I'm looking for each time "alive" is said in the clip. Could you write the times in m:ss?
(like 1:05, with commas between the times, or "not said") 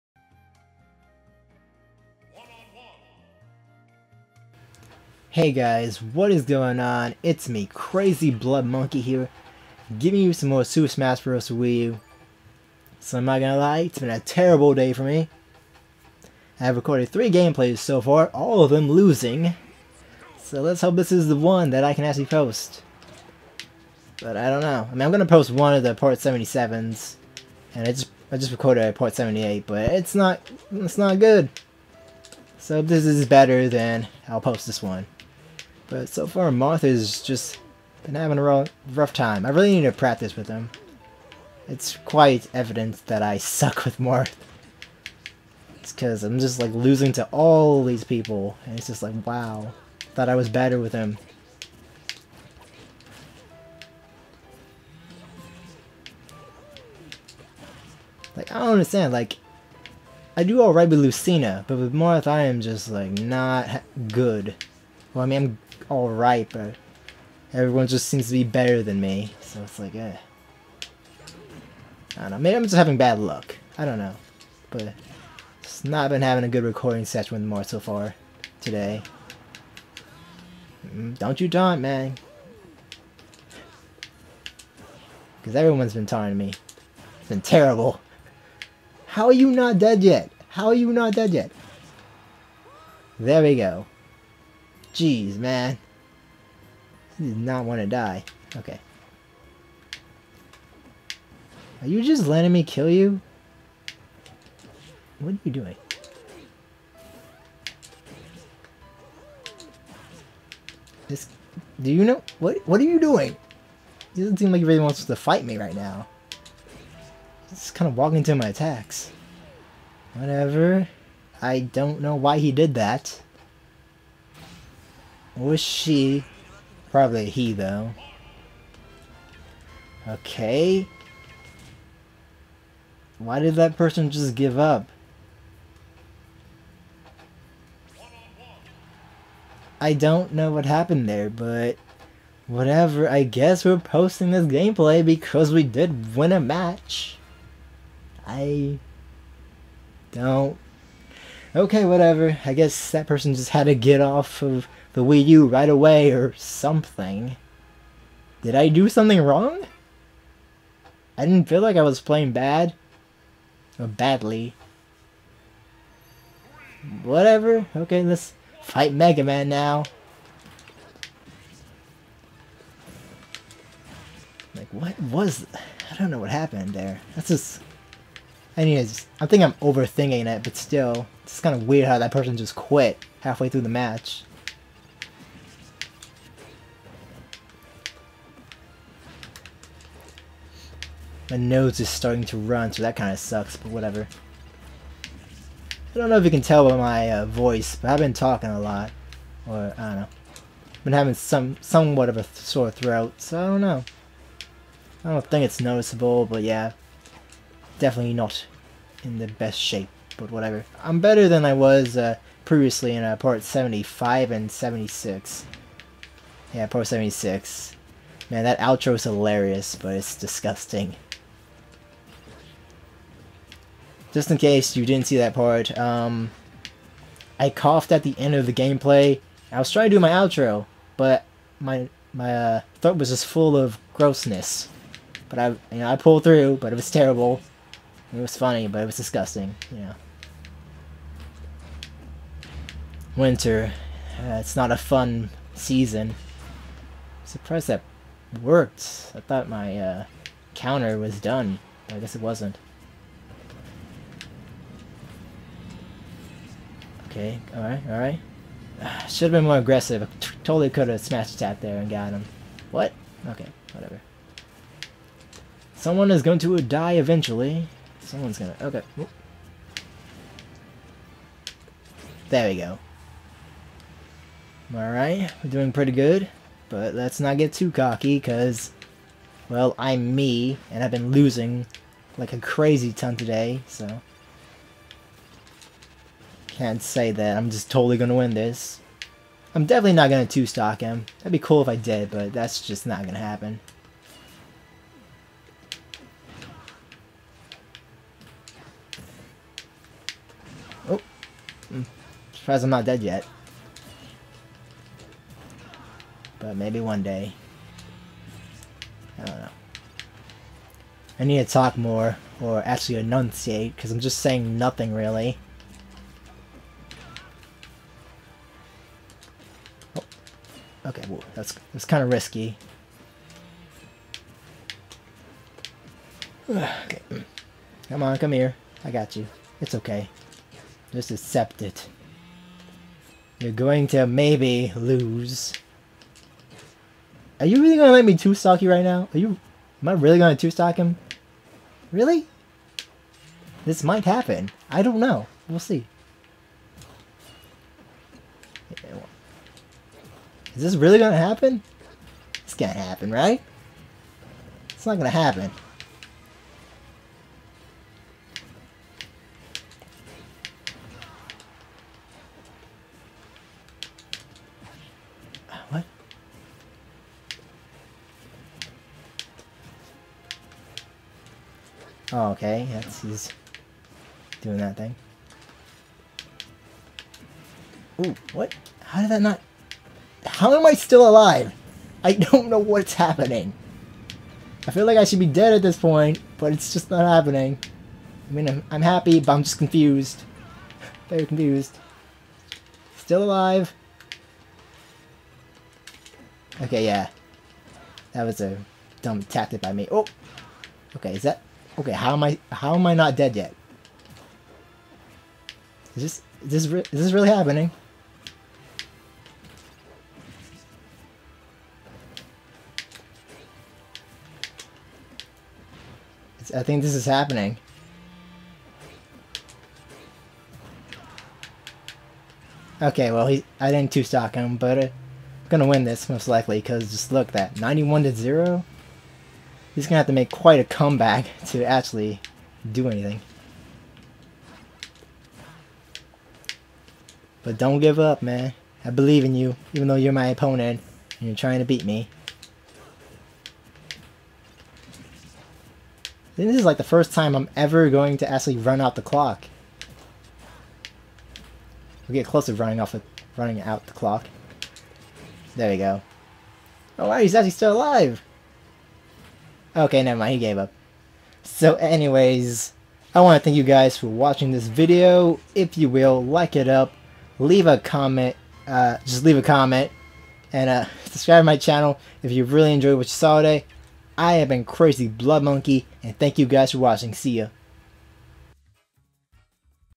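6:21, 6:33, 7:37.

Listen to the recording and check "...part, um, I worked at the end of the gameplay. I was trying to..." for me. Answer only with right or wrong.
wrong.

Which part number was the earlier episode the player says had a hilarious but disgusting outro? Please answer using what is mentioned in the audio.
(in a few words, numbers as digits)
76.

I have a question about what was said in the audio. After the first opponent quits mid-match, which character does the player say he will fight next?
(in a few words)
Mega Man.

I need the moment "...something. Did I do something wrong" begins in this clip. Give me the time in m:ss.
2:36.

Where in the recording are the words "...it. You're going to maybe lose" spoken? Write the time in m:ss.
5:31.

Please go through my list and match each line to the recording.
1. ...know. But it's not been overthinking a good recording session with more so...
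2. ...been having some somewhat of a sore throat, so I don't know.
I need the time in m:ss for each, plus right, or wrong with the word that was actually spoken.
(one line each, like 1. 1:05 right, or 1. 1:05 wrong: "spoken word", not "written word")
1. 1:13 wrong: "having", not "overthinking"
2. 3:20 right.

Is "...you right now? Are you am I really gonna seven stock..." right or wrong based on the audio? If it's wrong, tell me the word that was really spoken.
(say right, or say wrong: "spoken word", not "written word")
wrong: "two", not "seven".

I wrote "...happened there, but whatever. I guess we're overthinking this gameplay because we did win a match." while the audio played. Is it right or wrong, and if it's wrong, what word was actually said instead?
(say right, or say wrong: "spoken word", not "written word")
wrong: "posting", not "overthinking".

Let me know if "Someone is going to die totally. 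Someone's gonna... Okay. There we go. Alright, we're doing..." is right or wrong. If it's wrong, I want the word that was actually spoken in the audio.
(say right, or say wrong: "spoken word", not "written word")
wrong: "eventually", not "totally".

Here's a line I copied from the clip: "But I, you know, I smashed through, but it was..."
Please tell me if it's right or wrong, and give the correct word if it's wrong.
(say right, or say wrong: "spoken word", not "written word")
wrong: "pulled", not "smashed".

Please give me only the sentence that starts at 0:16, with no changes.
I've recorded three gameplays so far, all of them losing.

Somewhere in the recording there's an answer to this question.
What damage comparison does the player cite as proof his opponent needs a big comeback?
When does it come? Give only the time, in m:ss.
7:07.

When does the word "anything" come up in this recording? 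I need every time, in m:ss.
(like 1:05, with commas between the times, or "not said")
7:12.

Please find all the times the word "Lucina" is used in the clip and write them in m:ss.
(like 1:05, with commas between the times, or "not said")
1:00.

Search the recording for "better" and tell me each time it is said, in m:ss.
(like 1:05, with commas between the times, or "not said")
0:33, 0:50, 1:08, 3:31.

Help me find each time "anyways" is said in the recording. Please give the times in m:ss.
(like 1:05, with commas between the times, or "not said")
2:58, 7:41.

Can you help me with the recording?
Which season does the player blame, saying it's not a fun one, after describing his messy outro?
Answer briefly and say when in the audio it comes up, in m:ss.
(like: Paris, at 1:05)
Winter, at 4:03.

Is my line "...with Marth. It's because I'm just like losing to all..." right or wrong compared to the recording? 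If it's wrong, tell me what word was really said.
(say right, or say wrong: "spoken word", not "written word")
right.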